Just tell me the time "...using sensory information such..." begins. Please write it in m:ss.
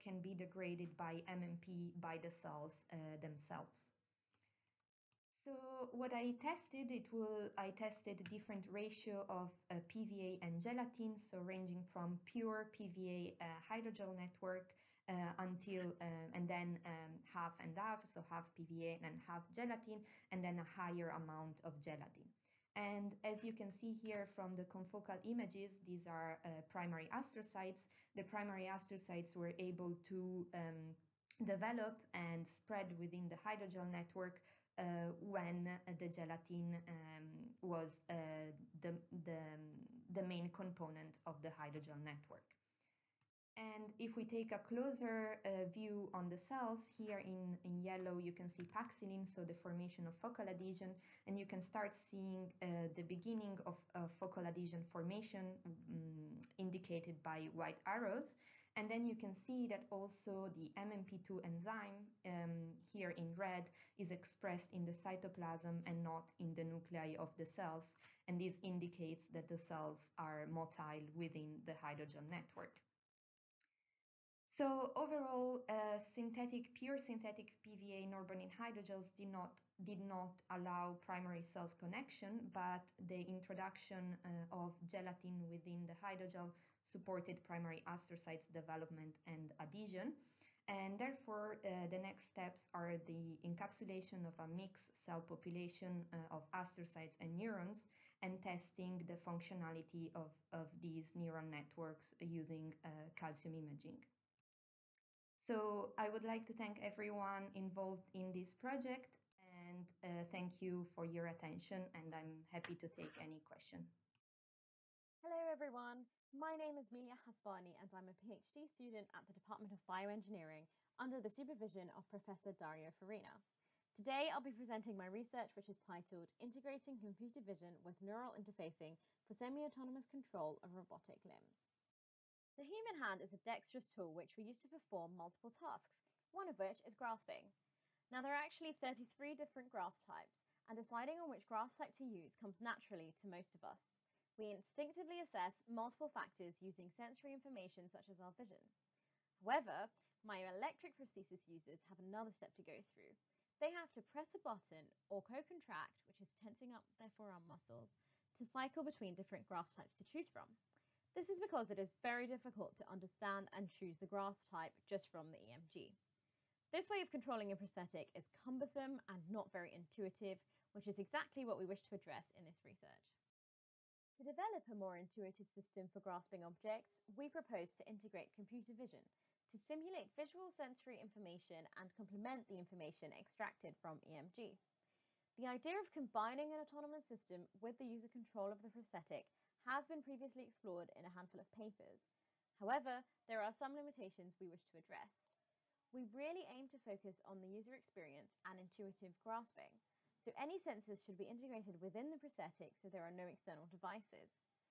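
2:26.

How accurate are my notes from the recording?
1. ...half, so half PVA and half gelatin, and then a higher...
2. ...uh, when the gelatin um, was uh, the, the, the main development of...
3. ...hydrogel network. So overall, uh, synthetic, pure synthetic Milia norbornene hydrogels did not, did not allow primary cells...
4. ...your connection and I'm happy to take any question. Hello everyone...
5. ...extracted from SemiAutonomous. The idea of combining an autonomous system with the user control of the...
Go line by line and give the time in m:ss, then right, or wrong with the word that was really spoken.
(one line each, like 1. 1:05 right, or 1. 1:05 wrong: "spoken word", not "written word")
1. 0:17 right
2. 0:34 wrong: "component", not "development"
3. 1:11 wrong: "PVA", not "Milia"
4. 1:51 wrong: "attention", not "connection"
5. 3:03 wrong: "EMG", not "SemiAutonomous".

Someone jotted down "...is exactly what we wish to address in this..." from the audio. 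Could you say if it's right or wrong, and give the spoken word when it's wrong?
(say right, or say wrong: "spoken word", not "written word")
right.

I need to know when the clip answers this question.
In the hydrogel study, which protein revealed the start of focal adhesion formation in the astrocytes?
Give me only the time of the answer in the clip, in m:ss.
0:48.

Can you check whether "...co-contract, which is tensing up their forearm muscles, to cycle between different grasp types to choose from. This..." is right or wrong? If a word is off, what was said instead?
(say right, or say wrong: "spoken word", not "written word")
right.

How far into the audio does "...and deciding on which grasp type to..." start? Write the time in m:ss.
2:20.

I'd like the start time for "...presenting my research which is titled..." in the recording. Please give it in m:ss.
2:04.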